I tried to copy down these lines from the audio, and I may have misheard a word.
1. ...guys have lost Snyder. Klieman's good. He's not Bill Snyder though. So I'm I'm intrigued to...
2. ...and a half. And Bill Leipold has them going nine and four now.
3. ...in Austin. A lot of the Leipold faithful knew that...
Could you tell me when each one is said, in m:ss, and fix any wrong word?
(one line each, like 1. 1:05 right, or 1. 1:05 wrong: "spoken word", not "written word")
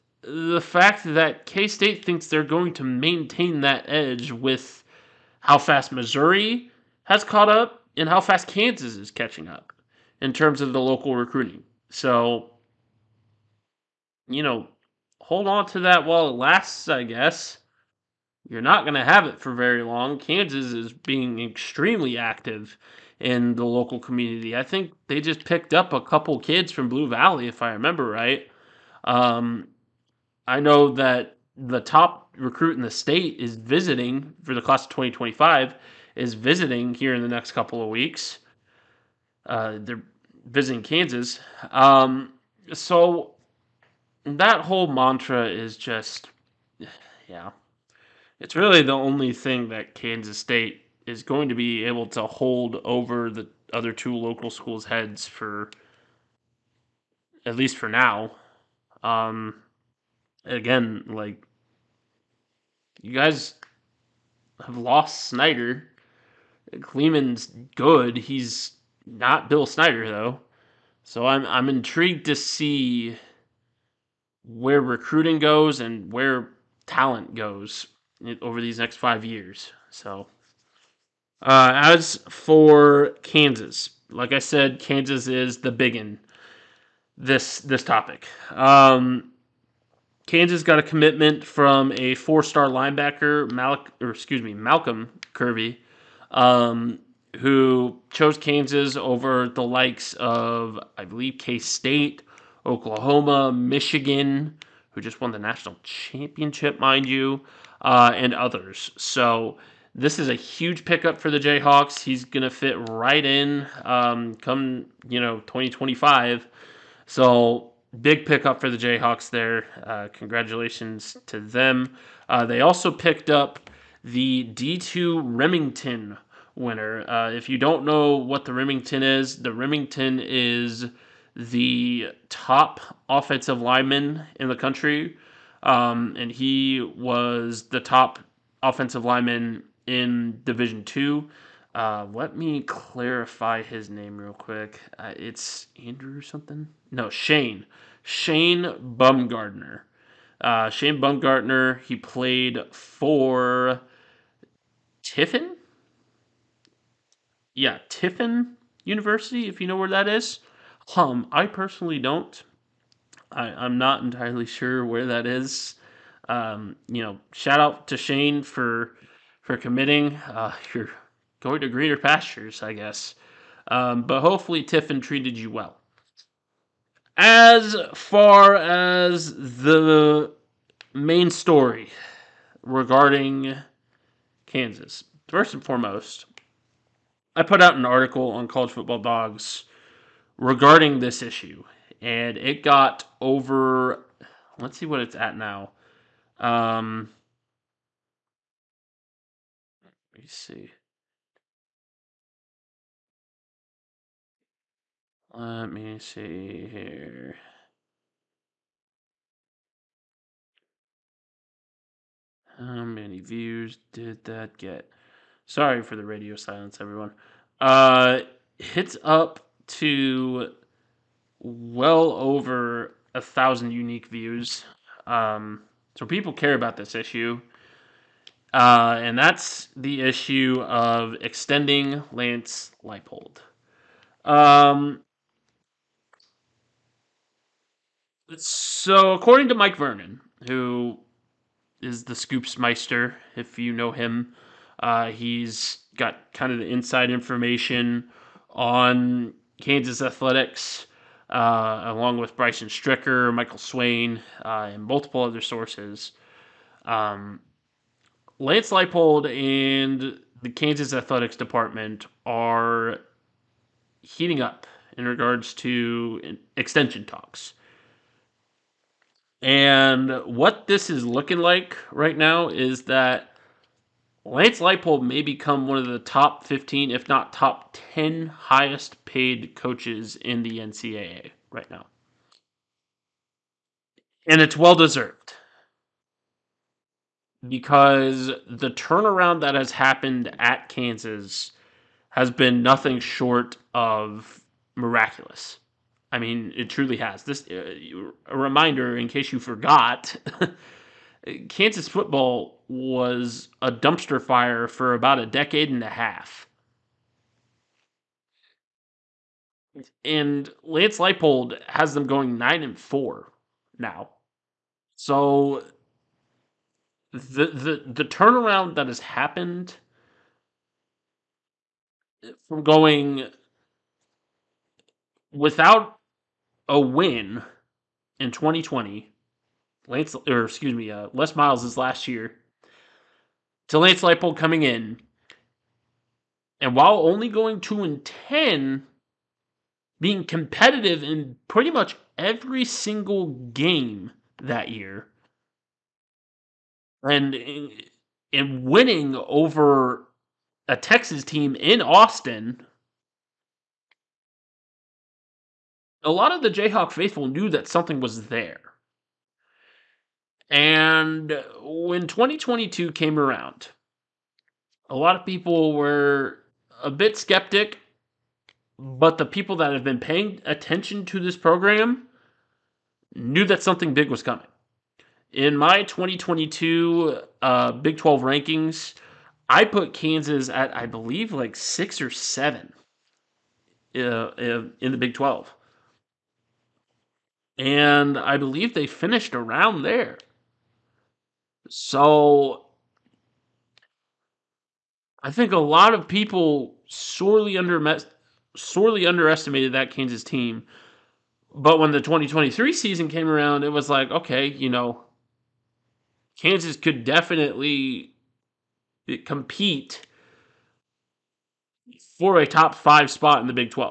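1. 1:03 right
2. 5:05 wrong: "Lance", not "Bill"
3. 5:51 wrong: "Jayhawk", not "Leipold".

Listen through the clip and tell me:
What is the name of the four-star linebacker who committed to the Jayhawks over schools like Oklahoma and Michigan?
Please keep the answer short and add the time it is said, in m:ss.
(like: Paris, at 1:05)
Malcolm Kirby, at 1:34.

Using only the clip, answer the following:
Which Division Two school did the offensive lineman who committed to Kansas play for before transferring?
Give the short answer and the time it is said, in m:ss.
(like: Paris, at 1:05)
Tiffin University, at 2:37.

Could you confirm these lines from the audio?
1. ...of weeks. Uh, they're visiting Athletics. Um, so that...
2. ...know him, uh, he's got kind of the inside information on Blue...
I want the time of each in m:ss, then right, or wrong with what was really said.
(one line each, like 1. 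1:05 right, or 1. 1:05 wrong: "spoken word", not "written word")
1. 0:37 wrong: "Kansas", not "Athletics"
2. 4:03 wrong: "Kansas", not "Blue".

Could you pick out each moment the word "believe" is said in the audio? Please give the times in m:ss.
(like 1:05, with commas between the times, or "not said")
1:41, 6:20, 6:28.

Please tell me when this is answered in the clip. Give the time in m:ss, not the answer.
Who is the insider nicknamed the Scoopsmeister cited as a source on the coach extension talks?
3:59.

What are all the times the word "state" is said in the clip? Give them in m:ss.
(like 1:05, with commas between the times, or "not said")
0:01, 0:32, 0:50, 1:41.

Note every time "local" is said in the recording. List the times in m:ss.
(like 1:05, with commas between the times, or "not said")
0:10, 0:23, 0:54.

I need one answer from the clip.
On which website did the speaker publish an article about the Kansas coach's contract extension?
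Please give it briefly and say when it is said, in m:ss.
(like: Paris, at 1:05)
College Football Dogs, at 3:08.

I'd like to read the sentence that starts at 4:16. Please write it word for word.
Um, Lance Leipold and the Kansas Athletics Department are heating up in regards to extension talks.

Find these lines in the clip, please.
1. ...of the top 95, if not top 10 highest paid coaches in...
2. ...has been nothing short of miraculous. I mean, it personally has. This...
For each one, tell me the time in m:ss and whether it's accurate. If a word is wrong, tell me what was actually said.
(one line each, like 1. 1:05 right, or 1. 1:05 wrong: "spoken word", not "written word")
1. 4:35 wrong: "15", not "95"
2. 4:52 wrong: "truly", not "personally".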